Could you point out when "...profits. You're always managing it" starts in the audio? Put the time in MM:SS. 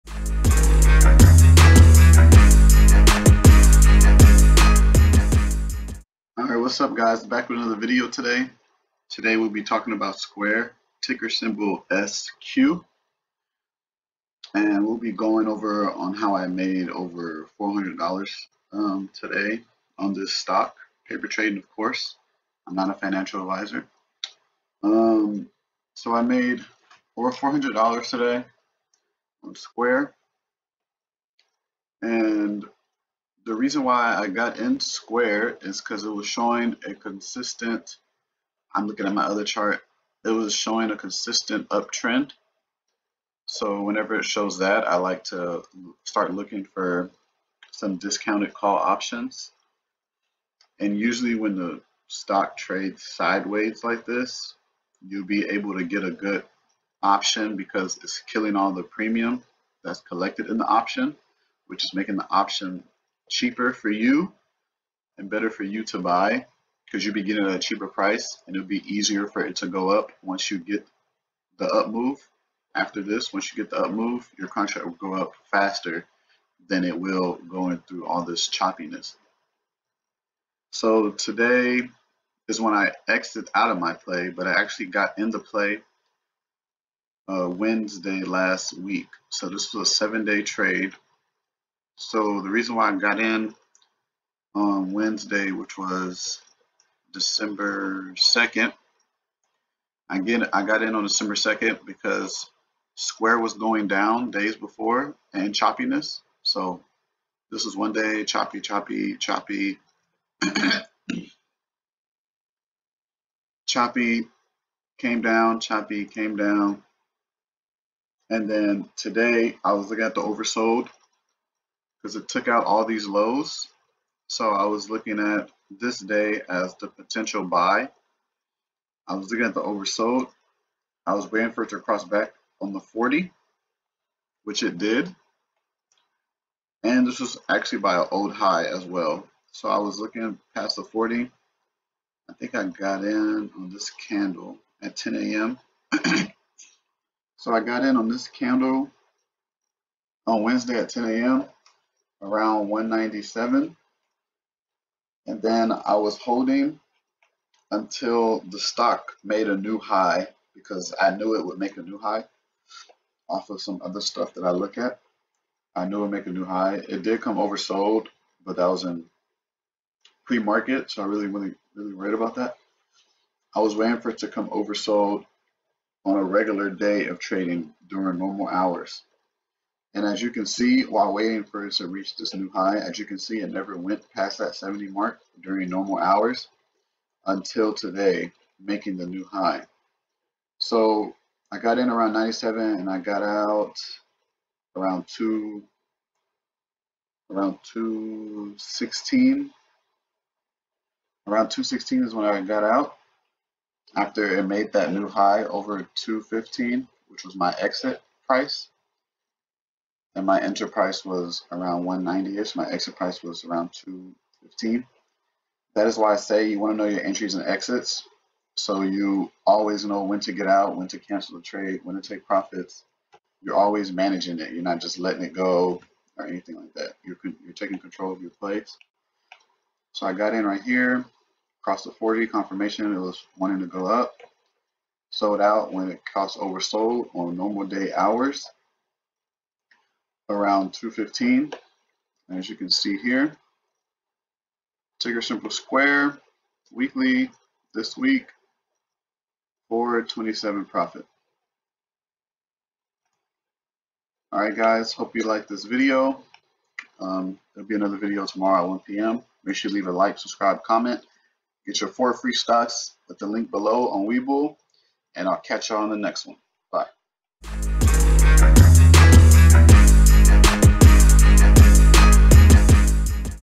03:42.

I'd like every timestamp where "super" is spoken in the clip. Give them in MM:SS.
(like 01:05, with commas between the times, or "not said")
not said.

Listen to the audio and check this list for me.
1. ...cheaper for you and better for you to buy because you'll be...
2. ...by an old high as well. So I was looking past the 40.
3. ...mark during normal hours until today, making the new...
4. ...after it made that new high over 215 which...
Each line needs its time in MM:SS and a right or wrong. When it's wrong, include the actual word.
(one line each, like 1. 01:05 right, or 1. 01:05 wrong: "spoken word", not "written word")
1. 01:03 right
2. 02:17 right
3. 03:04 right
4. 03:23 right.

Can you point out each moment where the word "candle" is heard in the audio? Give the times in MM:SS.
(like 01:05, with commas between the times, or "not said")
02:24, 02:28.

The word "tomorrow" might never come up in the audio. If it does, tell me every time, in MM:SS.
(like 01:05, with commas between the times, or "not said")
04:18.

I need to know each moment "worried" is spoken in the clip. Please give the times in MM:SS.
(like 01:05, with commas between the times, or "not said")
02:51.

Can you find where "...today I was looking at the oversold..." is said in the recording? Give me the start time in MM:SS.
01:58.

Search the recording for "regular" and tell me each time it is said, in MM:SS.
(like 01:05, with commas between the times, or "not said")
02:56.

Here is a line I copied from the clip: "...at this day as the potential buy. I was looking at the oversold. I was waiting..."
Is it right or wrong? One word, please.
right.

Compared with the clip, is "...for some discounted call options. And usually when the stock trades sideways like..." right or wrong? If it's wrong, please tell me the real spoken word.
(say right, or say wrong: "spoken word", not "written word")
right.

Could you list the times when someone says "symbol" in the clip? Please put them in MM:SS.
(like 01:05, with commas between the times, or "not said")
00:11, 04:05.